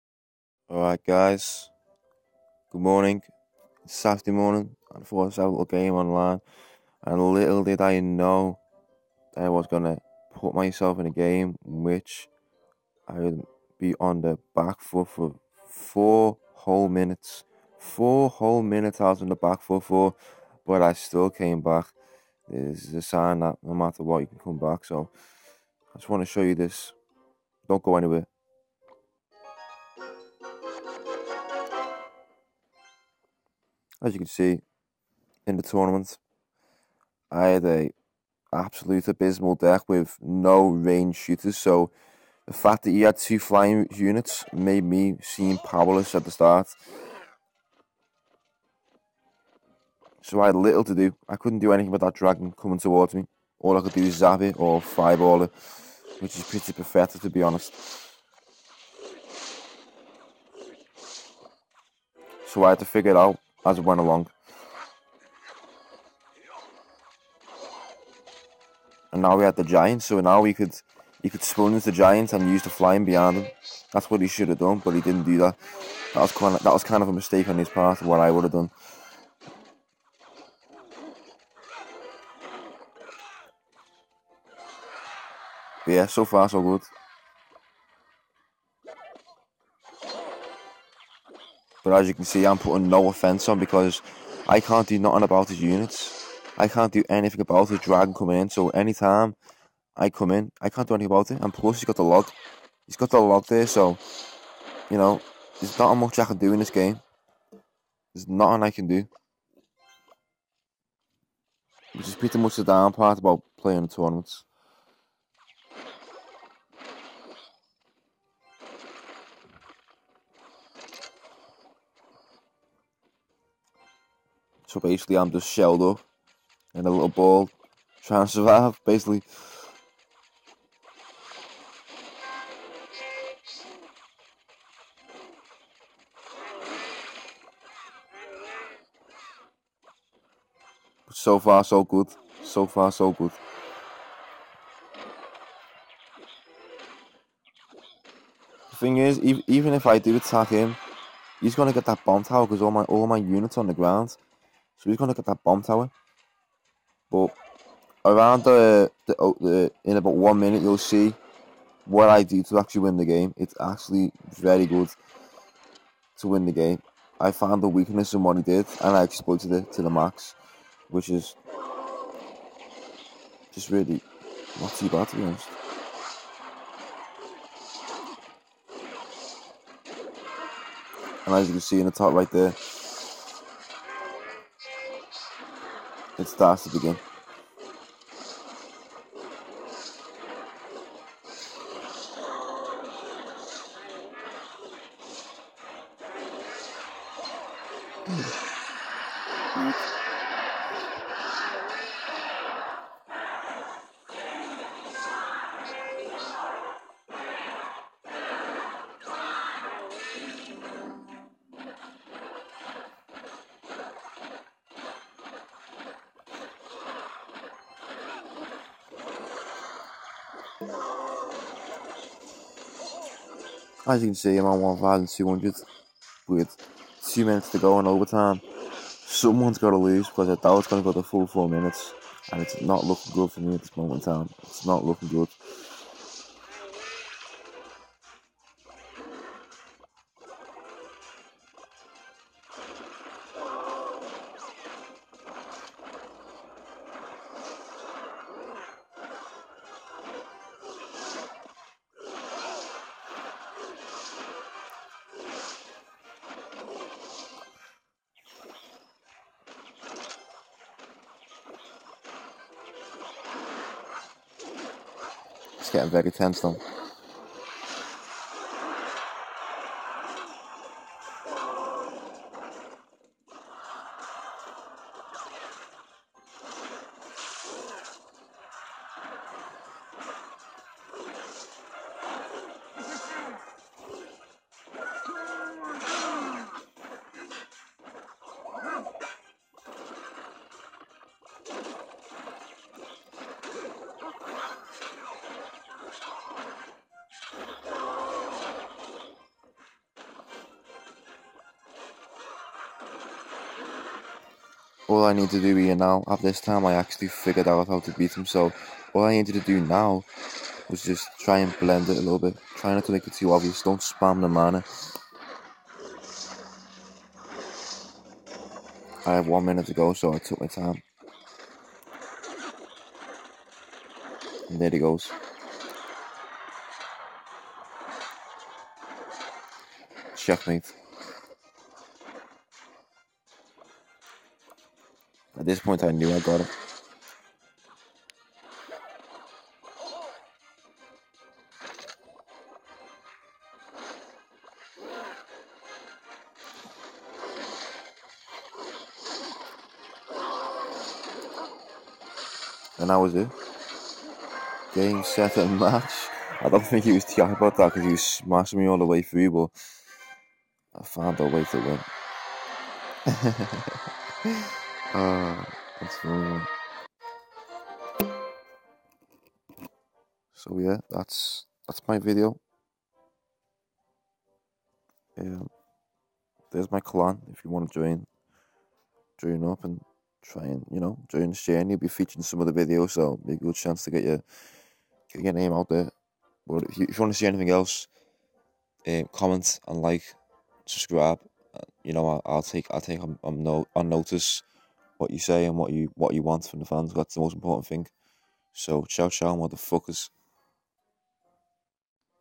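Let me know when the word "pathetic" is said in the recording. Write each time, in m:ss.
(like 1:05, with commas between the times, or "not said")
0:56.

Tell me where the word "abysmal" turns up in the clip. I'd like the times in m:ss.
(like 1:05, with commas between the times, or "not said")
0:39.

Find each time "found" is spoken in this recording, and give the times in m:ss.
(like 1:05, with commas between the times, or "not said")
2:47, 6:00.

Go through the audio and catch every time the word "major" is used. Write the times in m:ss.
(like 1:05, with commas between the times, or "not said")
not said.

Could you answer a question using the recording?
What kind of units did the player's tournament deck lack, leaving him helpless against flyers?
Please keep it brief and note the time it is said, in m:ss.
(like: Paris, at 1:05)
range shooters, at 0:40.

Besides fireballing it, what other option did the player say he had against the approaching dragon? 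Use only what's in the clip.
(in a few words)
zap it.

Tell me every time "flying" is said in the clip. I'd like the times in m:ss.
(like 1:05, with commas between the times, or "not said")
0:43, 1:12.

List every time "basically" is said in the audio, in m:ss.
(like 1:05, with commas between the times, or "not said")
2:04, 2:08.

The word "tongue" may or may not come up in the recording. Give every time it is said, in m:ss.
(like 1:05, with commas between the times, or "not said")
not said.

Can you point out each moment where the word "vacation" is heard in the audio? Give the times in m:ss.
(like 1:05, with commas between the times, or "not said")
not said.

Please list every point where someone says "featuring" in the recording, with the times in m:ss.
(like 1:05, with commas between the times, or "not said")
6:21.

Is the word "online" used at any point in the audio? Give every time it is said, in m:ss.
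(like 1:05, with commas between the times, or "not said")
0:05.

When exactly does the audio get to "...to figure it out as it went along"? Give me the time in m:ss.
1:02.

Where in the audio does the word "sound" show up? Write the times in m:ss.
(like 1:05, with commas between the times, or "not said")
not said.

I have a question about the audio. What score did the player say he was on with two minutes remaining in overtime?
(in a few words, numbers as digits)
1,200.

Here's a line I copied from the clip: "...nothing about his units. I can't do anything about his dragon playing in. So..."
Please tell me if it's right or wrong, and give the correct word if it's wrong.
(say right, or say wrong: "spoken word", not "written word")
wrong: "coming", not "playing".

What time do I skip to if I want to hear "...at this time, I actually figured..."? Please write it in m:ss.
5:06.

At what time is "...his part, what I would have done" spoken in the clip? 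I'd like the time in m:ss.
1:17.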